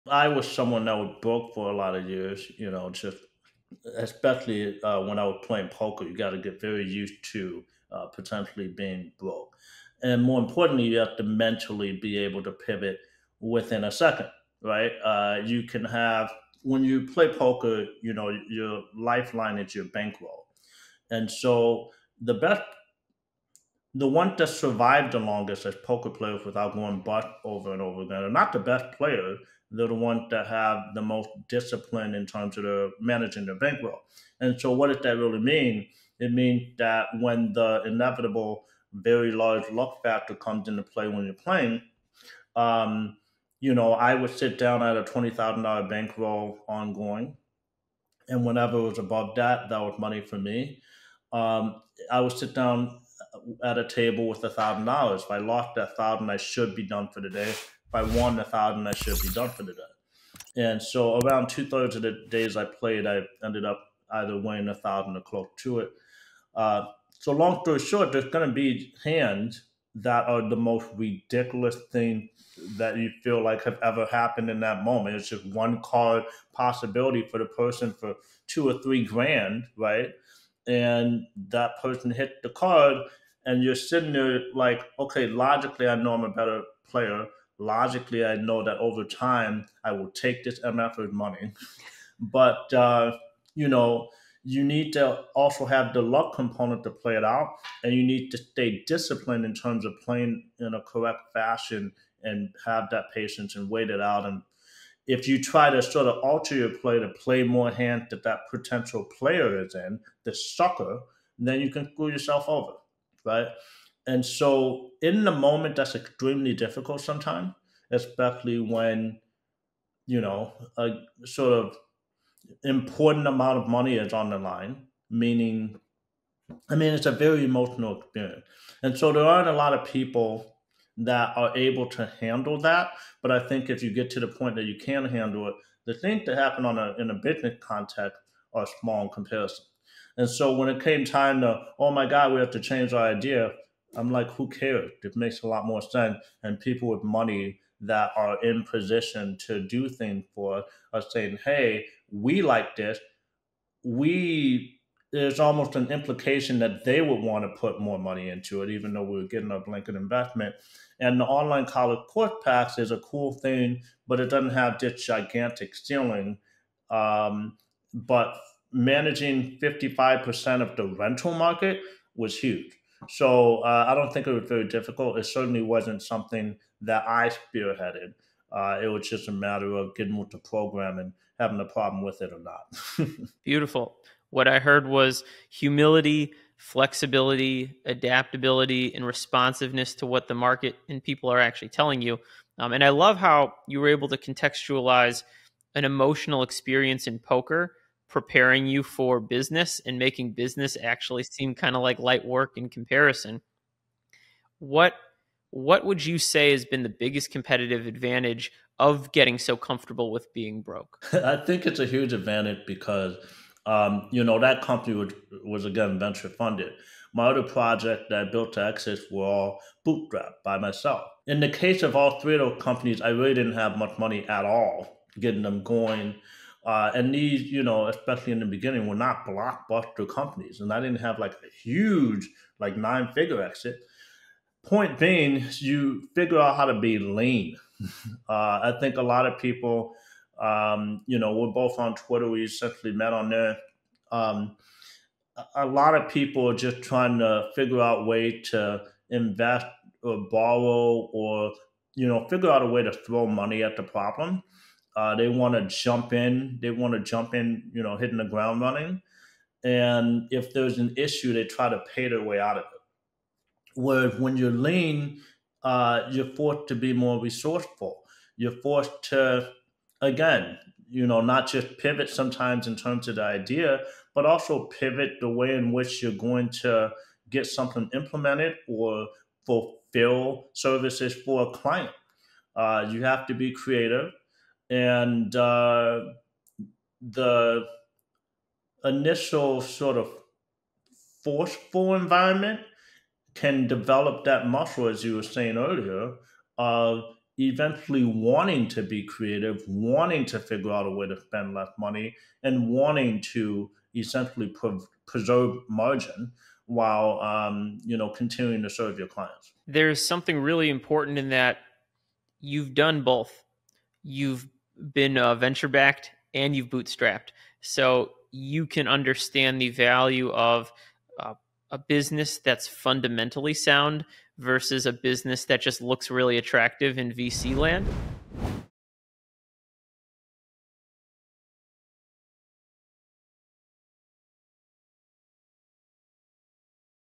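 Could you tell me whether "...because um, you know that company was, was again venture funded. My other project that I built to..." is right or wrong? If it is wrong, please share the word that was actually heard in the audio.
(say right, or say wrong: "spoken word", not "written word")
right.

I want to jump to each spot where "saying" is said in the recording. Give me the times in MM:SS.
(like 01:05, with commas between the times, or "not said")
02:31, 04:55.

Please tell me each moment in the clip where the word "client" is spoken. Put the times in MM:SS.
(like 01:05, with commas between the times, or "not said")
04:41, 05:09.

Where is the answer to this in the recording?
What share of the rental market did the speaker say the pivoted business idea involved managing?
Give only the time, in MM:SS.
02:49.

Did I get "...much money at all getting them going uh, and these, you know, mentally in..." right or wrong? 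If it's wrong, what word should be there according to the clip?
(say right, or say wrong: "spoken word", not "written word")
wrong: "especially", not "mentally".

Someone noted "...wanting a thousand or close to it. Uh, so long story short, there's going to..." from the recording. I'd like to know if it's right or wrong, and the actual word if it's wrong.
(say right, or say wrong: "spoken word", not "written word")
wrong: "winning", not "wanting".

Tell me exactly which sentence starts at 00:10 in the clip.
And more importantly, you have to mentally be able to pivot within a second, right?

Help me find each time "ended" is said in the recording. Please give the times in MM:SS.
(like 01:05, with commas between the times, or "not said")
01:03.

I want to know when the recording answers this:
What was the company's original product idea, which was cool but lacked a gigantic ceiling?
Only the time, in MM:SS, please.
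02:41.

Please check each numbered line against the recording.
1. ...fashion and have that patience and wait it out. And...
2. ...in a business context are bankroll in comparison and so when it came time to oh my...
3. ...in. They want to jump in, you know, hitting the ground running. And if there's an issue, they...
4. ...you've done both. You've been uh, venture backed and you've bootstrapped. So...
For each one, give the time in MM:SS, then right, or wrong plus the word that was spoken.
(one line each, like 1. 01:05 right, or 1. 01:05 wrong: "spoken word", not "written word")
1. 01:41 right
2. 02:16 wrong: "small", not "bankroll"
3. 04:16 right
4. 05:12 right.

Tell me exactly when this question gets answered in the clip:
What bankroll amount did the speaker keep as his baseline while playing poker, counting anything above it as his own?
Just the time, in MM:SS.
00:45.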